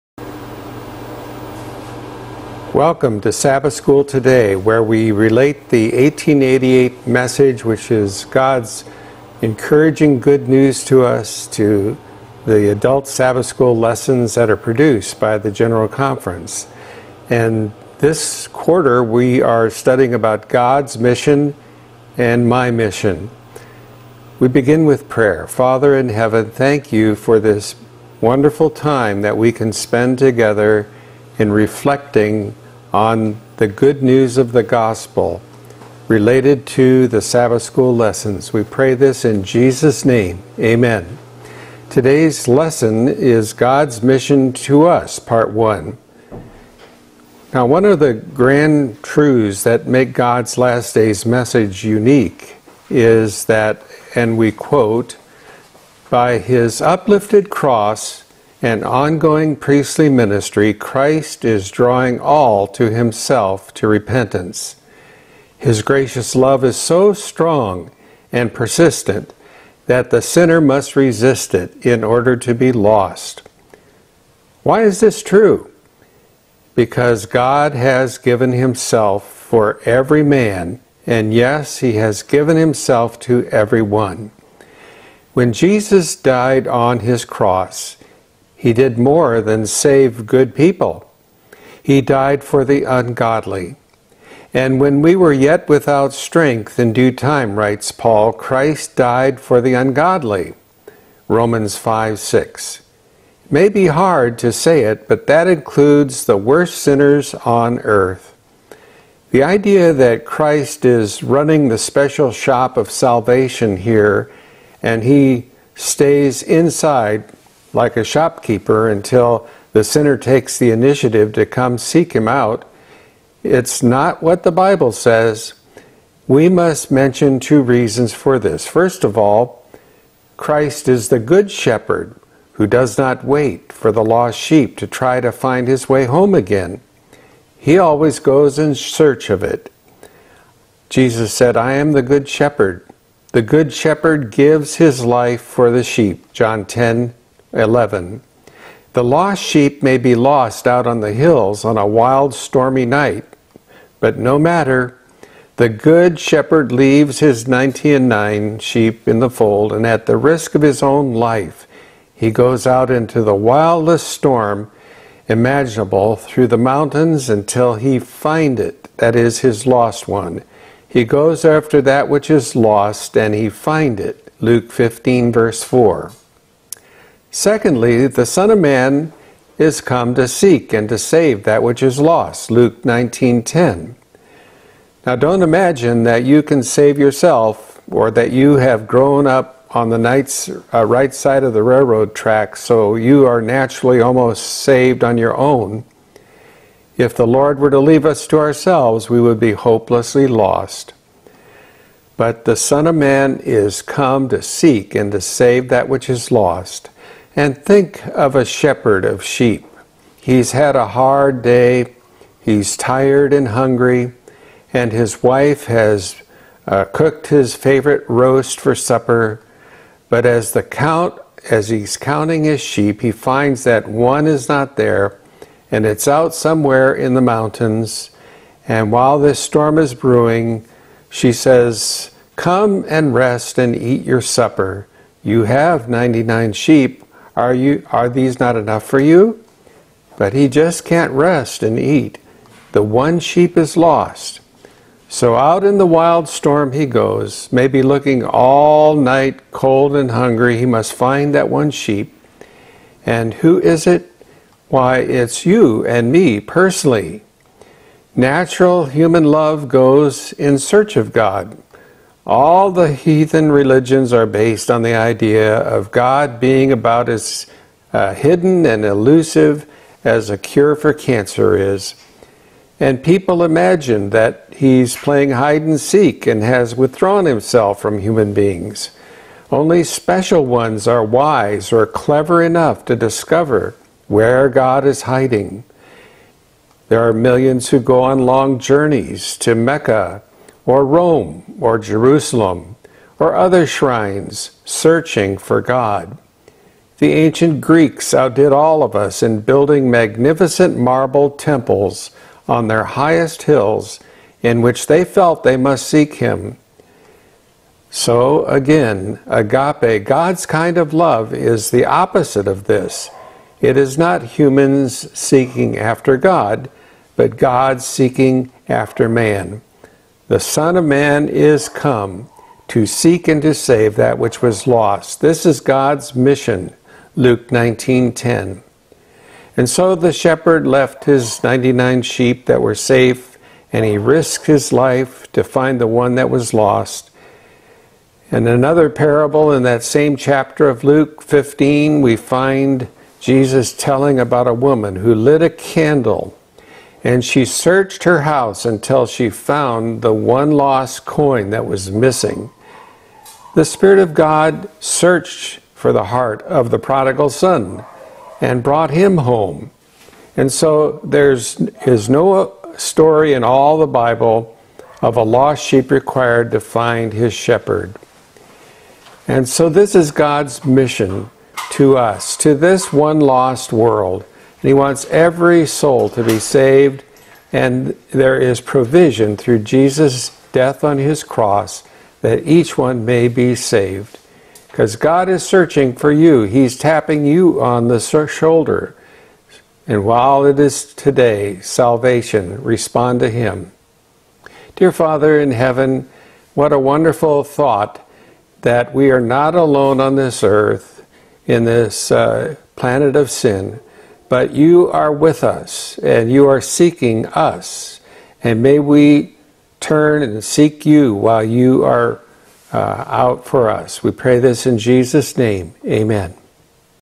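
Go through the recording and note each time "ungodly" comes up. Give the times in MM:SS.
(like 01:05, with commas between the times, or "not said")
01:32, 01:39.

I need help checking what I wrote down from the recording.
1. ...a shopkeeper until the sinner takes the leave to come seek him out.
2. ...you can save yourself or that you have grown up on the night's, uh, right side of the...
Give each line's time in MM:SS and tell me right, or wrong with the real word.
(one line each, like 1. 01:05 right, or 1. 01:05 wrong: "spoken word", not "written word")
1. 01:57 wrong: "initiative", not "leave"
2. 03:06 right.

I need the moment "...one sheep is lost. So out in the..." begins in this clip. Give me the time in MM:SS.
04:02.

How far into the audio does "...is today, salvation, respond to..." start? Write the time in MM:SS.
06:30.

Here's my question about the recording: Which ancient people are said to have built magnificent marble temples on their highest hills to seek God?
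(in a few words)
The ancient Greeks.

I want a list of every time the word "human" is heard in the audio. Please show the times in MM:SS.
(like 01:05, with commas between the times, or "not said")
04:18, 04:37, 05:14.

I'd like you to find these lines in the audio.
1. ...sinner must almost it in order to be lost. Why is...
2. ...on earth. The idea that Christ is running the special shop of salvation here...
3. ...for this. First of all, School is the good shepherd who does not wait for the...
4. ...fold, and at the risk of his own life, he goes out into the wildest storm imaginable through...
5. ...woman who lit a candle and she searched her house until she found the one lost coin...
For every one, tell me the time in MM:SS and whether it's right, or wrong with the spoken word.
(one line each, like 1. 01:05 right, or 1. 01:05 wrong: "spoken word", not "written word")
1. 01:10 wrong: "resist", not "almost"
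2. 01:47 right
3. 02:08 wrong: "Christ", not "School"
4. 02:39 right
5. 05:44 right.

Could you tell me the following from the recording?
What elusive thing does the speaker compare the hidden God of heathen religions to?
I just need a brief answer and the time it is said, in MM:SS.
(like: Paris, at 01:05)
A cure for cancer, at 04:30.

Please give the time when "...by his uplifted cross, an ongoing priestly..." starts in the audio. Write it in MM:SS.
00:56.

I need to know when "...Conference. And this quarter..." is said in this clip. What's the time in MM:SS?
00:15.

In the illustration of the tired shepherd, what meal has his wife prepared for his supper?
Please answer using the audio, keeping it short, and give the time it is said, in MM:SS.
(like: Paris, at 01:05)
His favorite roast, at 03:37.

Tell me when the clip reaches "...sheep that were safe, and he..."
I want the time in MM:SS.
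05:32.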